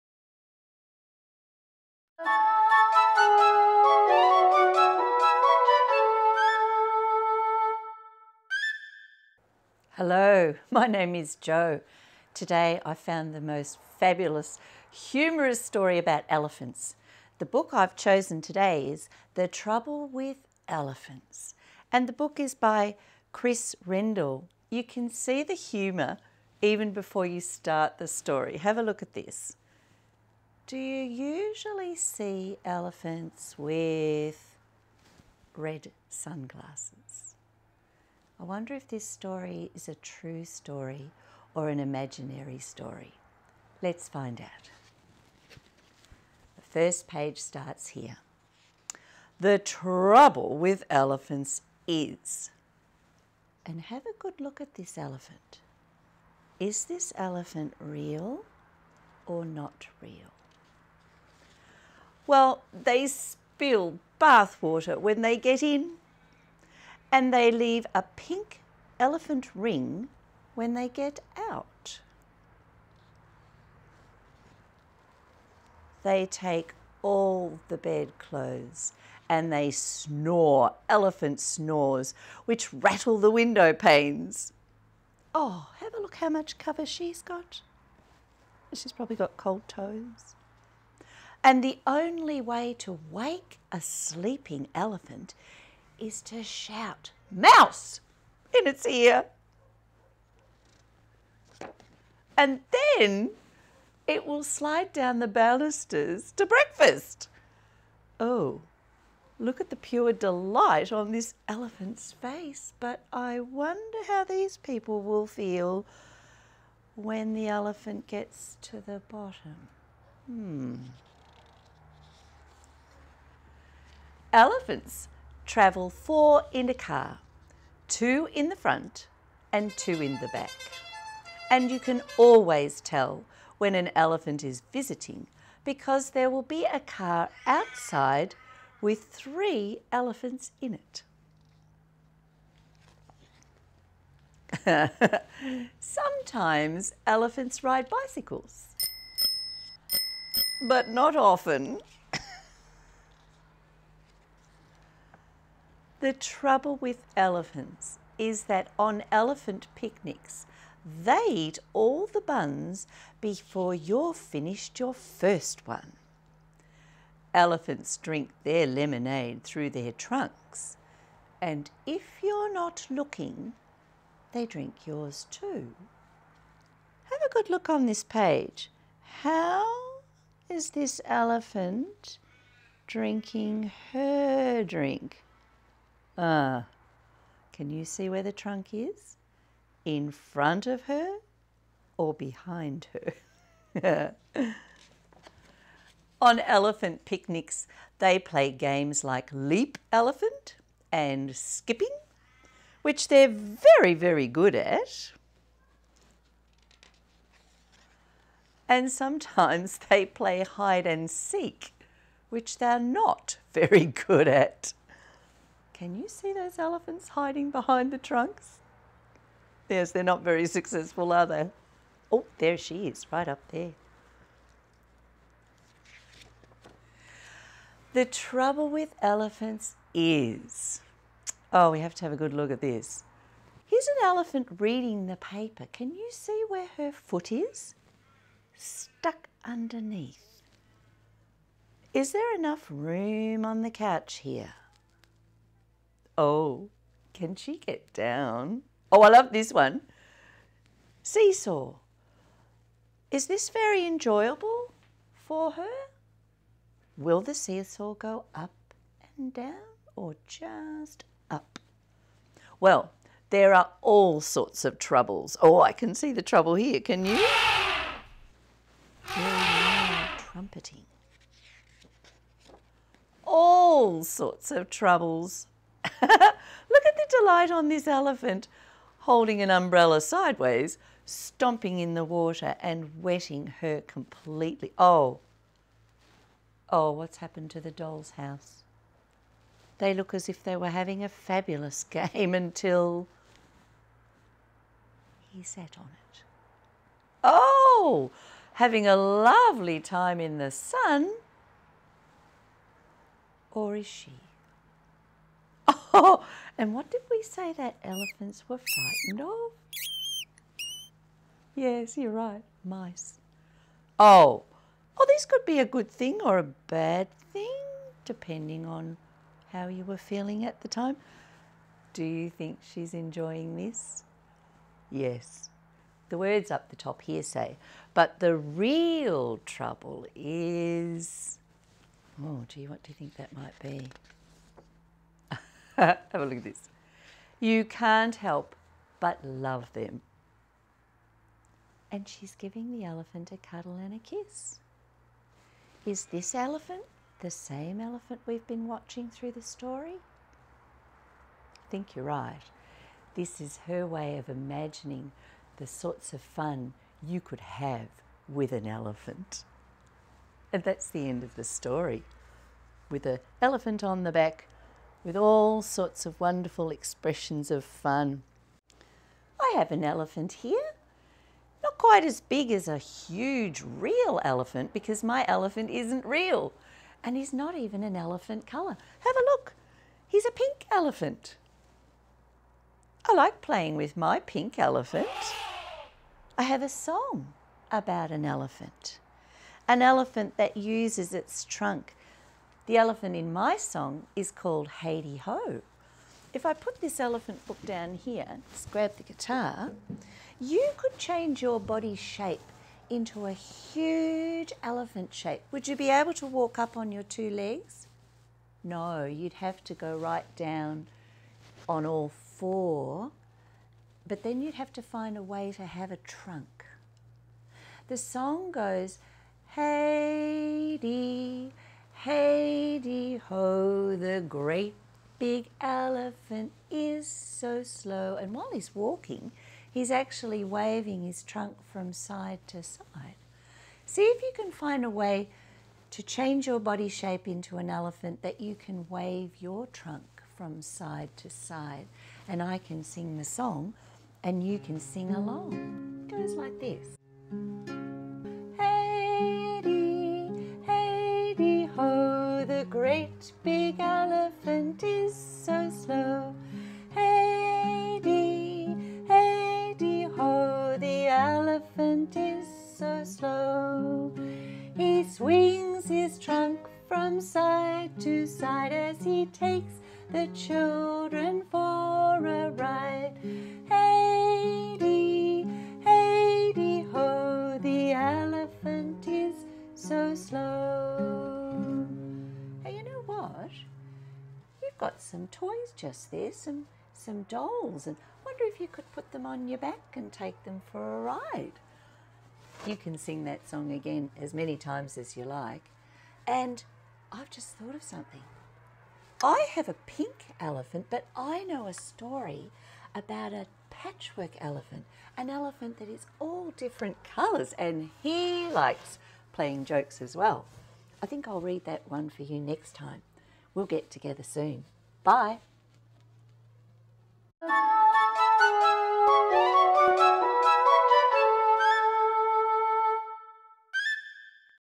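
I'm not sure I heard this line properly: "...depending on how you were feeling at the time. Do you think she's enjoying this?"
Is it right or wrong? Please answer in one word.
right.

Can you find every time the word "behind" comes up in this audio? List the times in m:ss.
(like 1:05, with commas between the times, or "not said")
3:12, 3:37.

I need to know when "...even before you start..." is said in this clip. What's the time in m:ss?
0:26.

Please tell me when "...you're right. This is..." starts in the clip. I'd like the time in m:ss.
5:51.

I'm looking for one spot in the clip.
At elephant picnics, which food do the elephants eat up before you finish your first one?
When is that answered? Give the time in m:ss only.
2:42.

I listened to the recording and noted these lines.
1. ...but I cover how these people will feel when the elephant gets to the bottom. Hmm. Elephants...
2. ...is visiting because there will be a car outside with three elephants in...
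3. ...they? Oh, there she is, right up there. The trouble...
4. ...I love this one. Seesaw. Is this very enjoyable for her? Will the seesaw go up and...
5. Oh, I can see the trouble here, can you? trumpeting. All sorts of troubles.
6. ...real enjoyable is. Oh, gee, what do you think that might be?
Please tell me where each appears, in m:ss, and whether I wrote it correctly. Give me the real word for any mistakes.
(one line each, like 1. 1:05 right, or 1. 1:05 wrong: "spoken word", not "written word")
1. 1:52 wrong: "wonder", not "cover"
2. 2:14 right
3. 3:41 right
4. 4:09 right
5. 4:25 right
6. 5:28 wrong: "trouble", not "enjoyable".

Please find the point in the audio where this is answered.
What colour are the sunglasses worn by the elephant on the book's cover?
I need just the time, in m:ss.
0:35.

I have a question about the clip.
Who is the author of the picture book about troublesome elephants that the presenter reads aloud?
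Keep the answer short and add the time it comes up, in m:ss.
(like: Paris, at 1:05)
Chris Riddell, at 0:23.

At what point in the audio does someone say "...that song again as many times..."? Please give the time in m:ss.
8:13.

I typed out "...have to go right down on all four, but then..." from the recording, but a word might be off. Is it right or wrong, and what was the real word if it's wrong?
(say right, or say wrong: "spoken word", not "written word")
right.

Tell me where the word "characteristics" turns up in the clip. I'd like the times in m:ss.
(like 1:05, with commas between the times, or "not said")
not said.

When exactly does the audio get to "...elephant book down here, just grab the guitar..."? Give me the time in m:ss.
6:36.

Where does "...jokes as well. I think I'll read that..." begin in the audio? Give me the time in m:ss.
8:29.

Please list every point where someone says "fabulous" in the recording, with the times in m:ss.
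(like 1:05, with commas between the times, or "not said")
0:13, 4:51.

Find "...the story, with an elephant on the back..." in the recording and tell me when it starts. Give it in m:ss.
6:01.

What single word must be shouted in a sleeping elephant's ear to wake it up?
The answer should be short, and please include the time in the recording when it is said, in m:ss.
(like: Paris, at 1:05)
Mouse, at 1:37.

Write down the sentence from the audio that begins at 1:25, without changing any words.
Oh, have a look how much cover she's got.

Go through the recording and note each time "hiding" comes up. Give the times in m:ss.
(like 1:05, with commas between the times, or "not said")
3:37.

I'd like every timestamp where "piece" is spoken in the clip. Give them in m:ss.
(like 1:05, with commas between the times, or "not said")
not said.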